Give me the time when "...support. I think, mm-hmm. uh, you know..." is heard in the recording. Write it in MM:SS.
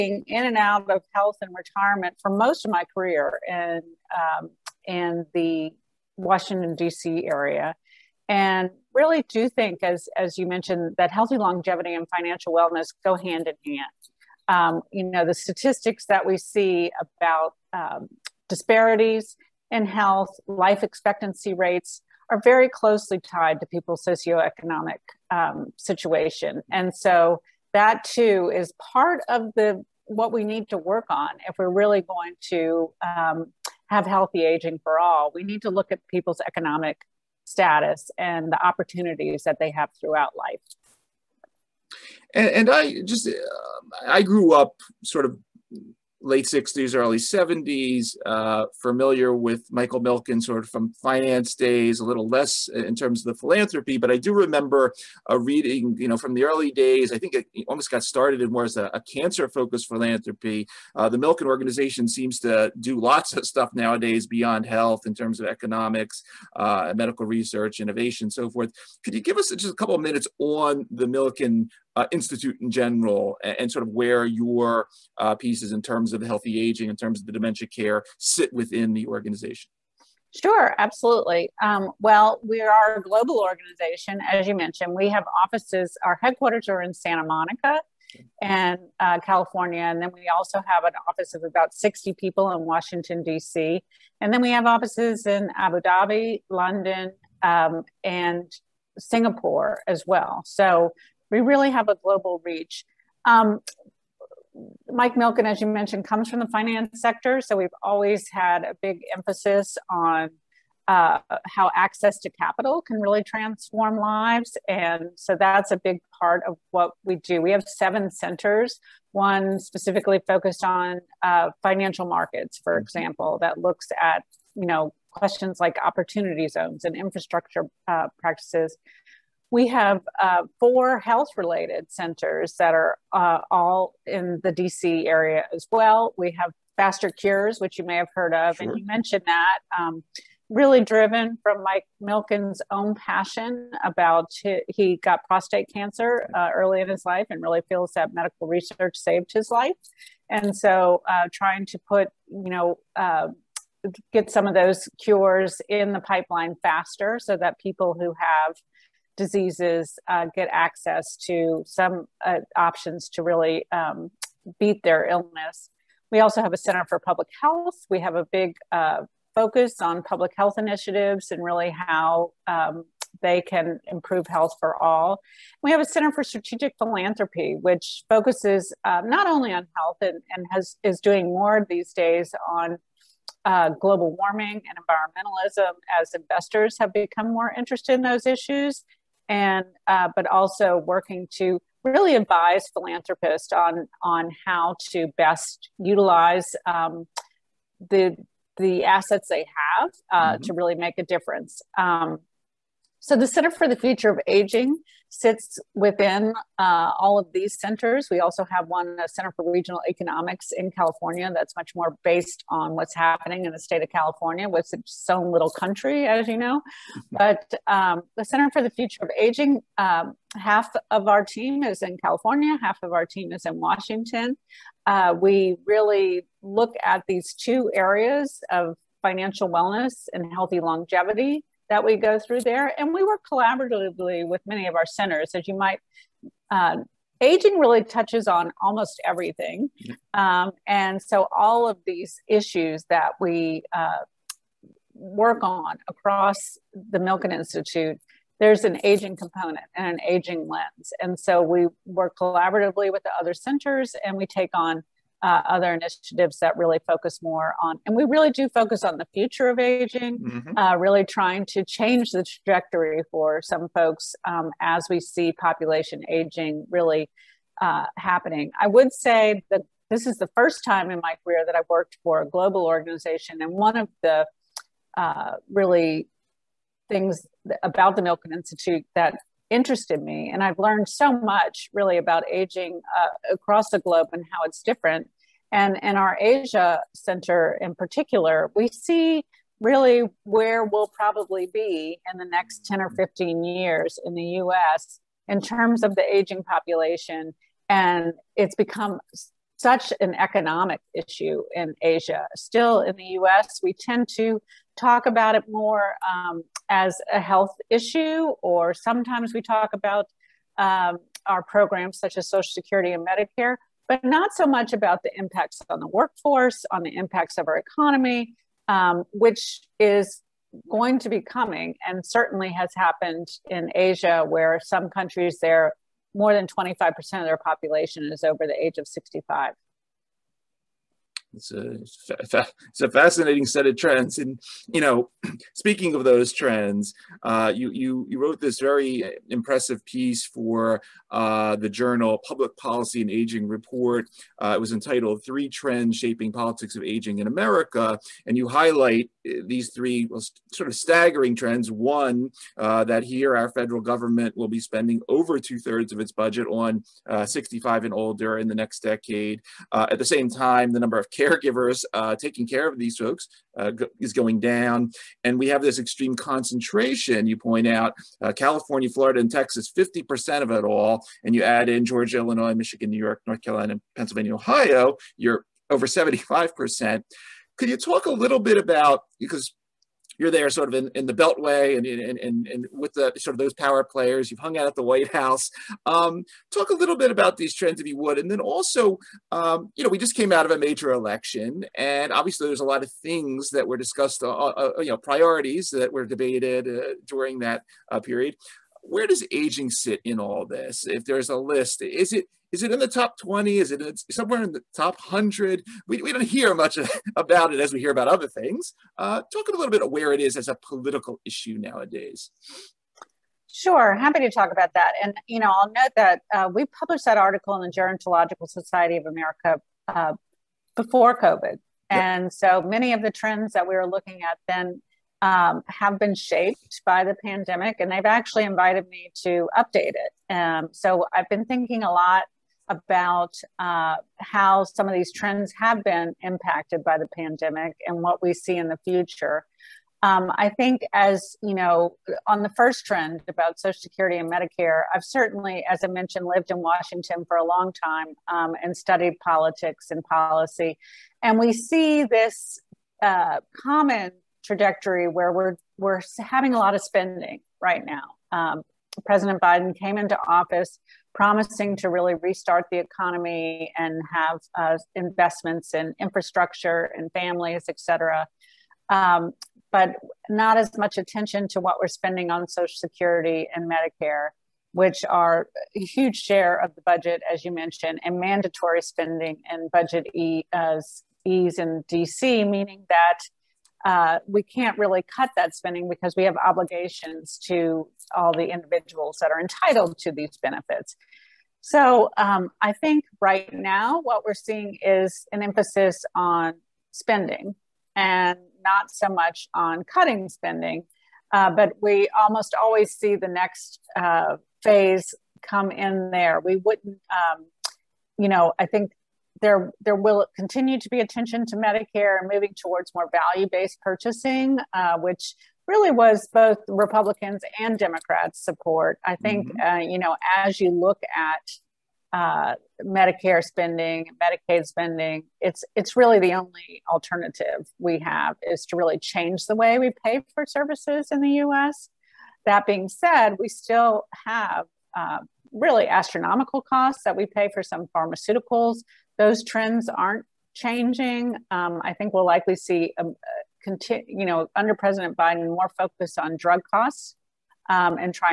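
08:38.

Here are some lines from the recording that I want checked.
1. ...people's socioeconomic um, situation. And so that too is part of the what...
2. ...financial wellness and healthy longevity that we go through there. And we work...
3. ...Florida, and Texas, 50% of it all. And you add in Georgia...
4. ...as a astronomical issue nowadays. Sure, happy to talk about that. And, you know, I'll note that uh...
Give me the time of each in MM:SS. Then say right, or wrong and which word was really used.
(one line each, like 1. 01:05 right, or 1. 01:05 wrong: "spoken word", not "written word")
1. 00:23 right
2. 03:49 right
3. 06:08 right
4. 06:50 wrong: "political", not "astronomical".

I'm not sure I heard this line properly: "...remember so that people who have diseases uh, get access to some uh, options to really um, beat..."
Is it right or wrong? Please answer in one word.
wrong.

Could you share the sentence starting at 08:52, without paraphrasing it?
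That being said, we still have uh, really astronomical costs that we pay for some pharmaceuticals, those trends aren't changing.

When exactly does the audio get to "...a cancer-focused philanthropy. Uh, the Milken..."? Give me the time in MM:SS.
00:58.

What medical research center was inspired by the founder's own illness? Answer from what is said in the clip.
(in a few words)
FasterCures.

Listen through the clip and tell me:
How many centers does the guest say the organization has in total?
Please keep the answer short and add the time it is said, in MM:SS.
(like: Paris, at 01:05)
7, at 01:57.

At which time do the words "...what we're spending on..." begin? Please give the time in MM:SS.
07:51.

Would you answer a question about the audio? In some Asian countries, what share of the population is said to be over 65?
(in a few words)
More than 25%.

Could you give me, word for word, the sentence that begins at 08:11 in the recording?
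So um, I think right now what we're seeing is an emphasis on spending and not so much on cutting spending.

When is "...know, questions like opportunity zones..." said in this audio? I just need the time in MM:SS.
02:04.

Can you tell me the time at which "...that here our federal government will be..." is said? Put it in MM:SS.
05:52.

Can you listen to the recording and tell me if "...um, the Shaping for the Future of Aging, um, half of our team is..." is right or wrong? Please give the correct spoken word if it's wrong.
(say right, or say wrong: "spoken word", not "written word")
wrong: "Center", not "Shaping".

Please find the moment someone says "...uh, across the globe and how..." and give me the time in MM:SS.
04:42.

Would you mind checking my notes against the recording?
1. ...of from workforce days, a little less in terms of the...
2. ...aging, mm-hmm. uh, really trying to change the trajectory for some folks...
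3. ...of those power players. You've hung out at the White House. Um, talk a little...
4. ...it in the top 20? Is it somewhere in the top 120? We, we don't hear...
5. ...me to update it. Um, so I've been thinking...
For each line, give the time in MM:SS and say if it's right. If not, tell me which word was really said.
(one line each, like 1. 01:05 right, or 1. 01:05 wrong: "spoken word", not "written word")
1. 00:50 wrong: "finance", not "workforce"
2. 04:19 right
3. 06:23 right
4. 06:42 wrong: "100", not "120"
5. 07:08 right.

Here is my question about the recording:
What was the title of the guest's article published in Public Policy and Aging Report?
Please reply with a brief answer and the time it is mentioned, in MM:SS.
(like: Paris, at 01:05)
Three Trends Shaping Politics of Aging in America, at 05:45.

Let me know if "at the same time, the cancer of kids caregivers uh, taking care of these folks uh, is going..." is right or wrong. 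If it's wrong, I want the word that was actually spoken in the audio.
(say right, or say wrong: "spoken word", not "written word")
wrong: "number", not "cancer".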